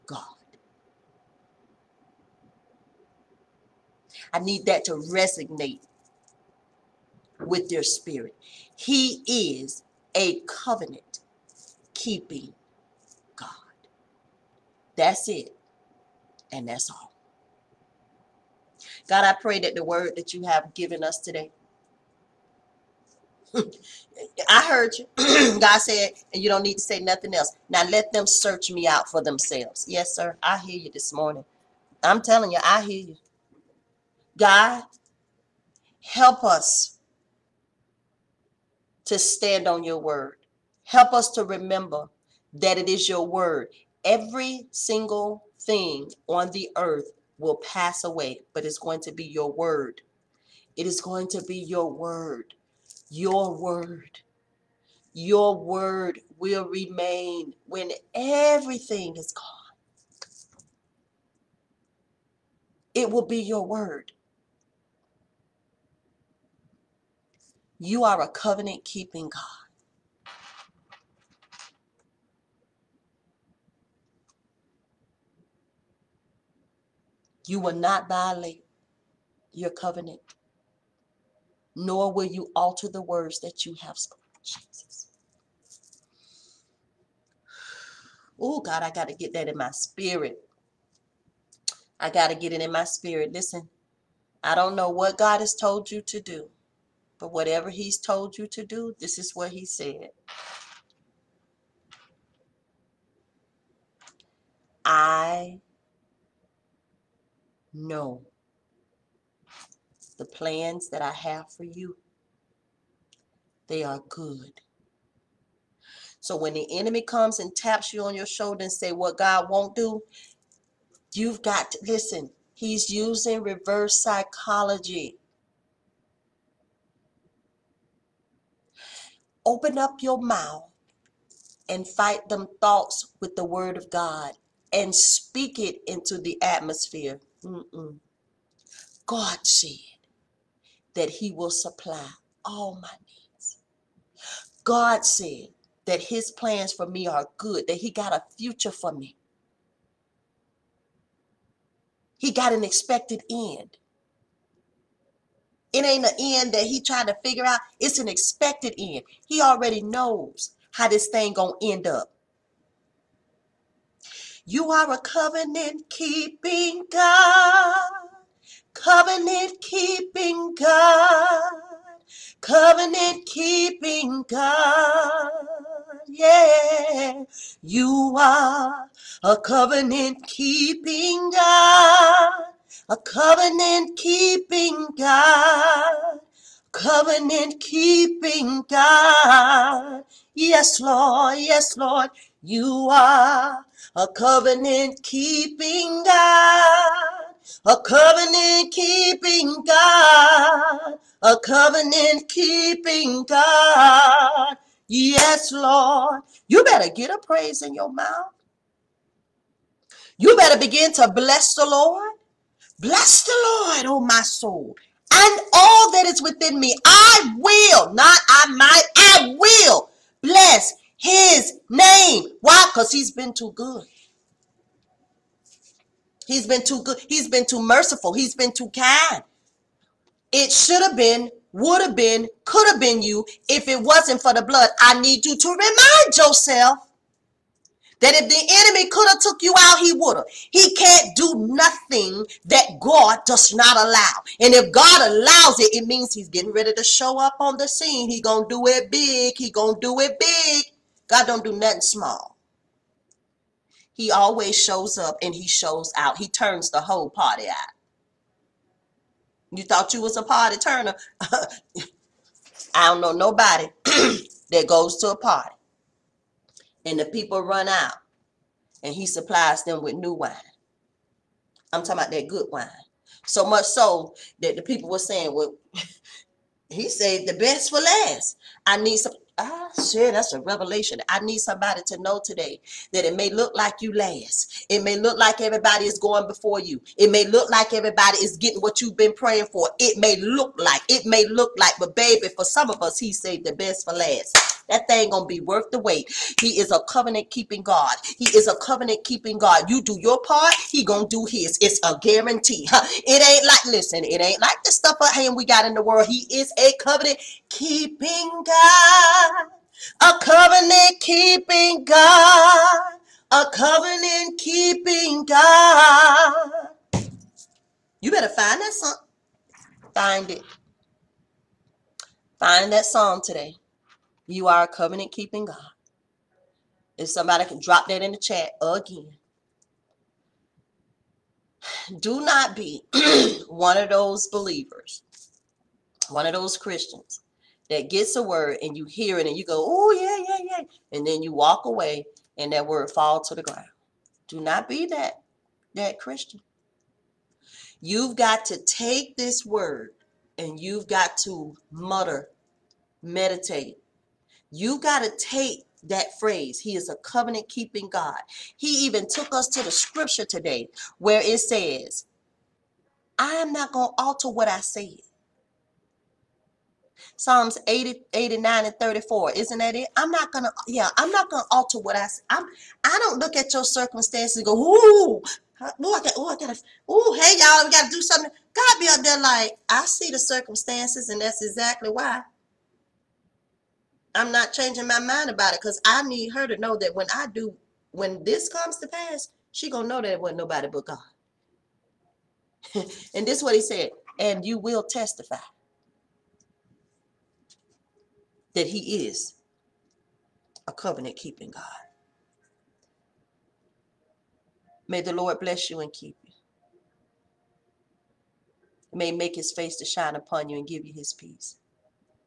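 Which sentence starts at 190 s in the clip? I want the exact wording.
Yes, Lord, yes, Lord, you are a covenant keeping God a covenant keeping God, a covenant keeping God.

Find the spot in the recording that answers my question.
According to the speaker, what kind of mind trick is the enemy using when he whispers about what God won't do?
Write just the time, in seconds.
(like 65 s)
123 s.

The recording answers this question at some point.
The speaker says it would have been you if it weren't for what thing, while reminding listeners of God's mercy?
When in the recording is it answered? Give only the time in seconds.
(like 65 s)
234 s.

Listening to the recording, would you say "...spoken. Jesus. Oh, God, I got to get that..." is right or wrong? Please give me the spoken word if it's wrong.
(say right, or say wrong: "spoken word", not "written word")
right.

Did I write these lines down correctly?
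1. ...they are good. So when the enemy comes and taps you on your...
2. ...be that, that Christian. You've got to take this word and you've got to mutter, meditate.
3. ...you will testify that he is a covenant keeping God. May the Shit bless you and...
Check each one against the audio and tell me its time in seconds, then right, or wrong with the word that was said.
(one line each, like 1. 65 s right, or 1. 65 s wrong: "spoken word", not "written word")
1. 113 s right
2. 344 s right
3. 394 s wrong: "Lord", not "Shit".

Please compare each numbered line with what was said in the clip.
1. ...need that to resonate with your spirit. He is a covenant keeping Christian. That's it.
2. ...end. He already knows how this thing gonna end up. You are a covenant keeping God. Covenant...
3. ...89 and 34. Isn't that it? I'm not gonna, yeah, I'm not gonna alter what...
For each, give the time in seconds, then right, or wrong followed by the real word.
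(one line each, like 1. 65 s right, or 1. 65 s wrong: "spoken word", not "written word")
1. 4 s wrong: "God", not "Christian"
2. 158 s right
3. 368 s right.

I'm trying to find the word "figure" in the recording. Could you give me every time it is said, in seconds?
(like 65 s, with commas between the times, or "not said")
157 s.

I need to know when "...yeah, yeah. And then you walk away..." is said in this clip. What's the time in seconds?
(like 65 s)
340 s.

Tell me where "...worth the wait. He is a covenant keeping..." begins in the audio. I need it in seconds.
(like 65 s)
295 s.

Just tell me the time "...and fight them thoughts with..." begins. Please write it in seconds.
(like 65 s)
131 s.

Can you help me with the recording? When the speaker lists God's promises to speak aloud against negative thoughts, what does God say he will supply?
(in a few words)
All my needs.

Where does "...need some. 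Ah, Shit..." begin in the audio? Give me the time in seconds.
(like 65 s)
278 s.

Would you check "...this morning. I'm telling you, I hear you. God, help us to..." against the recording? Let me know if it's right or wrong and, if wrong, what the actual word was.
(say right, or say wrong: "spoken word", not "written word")
right.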